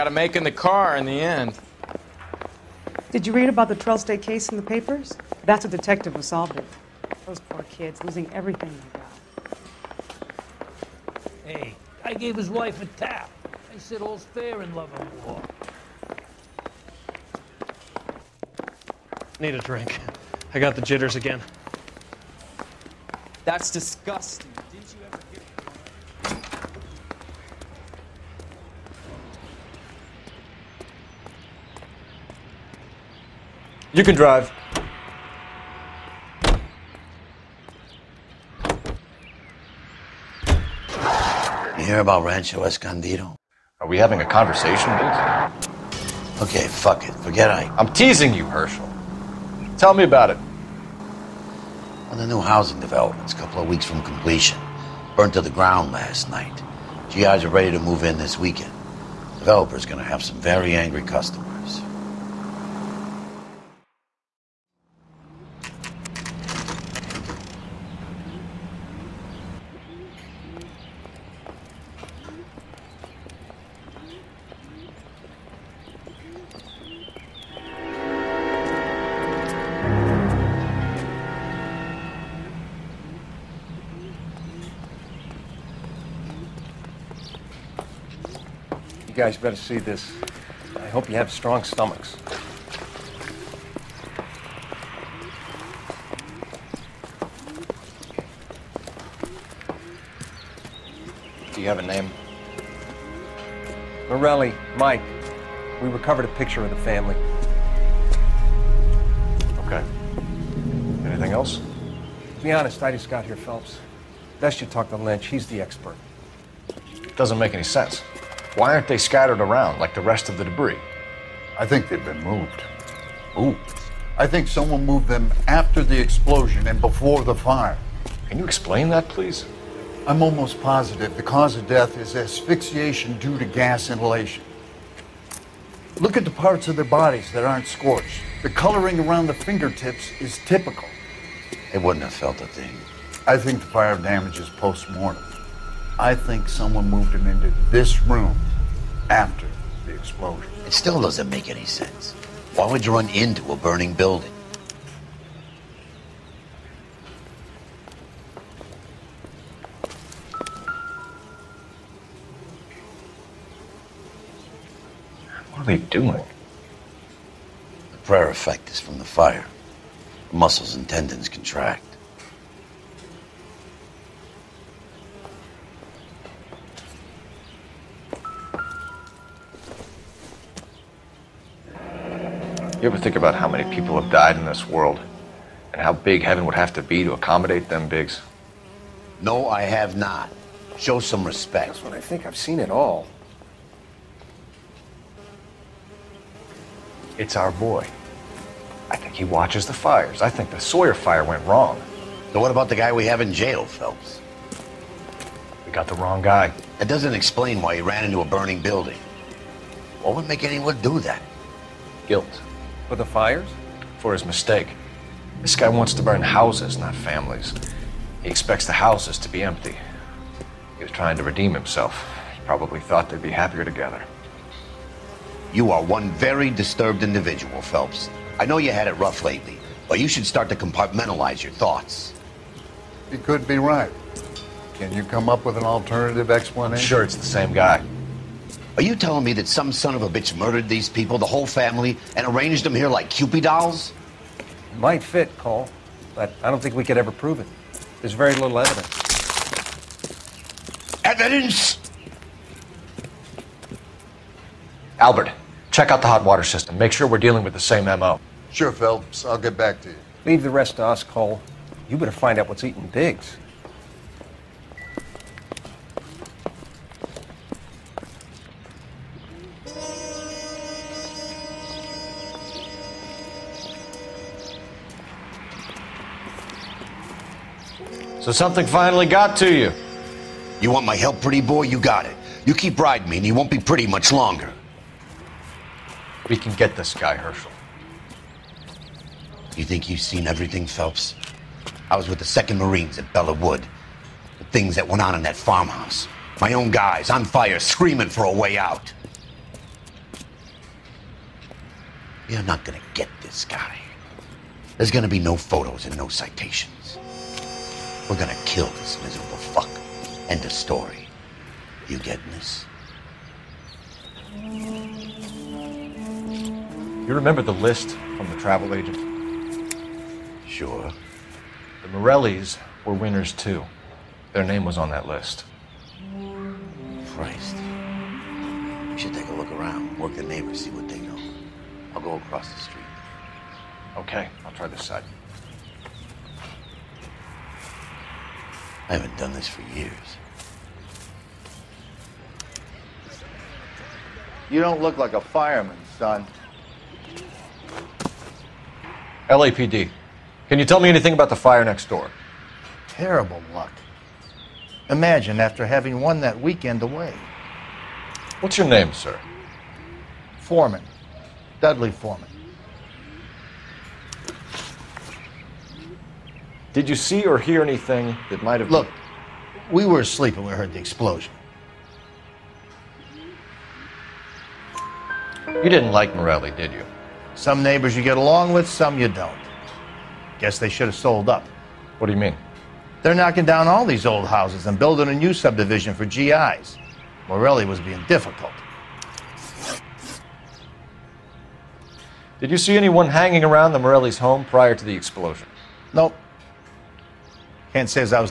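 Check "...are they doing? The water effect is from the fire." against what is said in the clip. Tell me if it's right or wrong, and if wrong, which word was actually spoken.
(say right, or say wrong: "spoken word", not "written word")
wrong: "prayer", not "water".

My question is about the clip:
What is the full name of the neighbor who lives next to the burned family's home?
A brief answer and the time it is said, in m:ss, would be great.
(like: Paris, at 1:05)
Dudley Foreman, at 6:01.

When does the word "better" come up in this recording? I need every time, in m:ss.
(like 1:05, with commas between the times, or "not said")
1:29, 4:21.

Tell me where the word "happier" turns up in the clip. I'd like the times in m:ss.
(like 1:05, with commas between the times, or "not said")
3:43.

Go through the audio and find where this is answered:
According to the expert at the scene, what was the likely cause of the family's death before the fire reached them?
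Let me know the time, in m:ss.
2:12.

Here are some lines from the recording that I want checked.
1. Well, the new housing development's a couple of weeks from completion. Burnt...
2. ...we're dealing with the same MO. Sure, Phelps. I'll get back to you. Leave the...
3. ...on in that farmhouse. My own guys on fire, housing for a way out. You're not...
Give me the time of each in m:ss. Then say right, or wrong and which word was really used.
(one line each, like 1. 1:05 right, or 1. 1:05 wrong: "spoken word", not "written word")
1. 0:52 right
2. 4:17 right
3. 4:54 wrong: "screaming", not "housing".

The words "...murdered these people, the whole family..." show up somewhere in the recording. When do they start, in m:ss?
4:00.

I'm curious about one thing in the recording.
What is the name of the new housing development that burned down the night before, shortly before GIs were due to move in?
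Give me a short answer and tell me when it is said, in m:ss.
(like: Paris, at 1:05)
Rancho Escondido, at 0:42.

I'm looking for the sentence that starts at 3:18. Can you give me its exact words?
I think he watches the fires.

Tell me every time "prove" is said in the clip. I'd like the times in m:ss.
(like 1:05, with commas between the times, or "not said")
4:07.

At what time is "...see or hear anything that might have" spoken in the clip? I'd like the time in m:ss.
6:06.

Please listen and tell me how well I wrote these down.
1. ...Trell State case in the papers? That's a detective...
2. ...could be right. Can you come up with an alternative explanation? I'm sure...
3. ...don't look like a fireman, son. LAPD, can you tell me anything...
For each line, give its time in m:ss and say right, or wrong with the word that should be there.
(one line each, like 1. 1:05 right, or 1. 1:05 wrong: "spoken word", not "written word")
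1. 0:03 right
2. 3:53 right
3. 5:44 right.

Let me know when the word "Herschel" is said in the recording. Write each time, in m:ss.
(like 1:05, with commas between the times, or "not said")
0:48, 4:47.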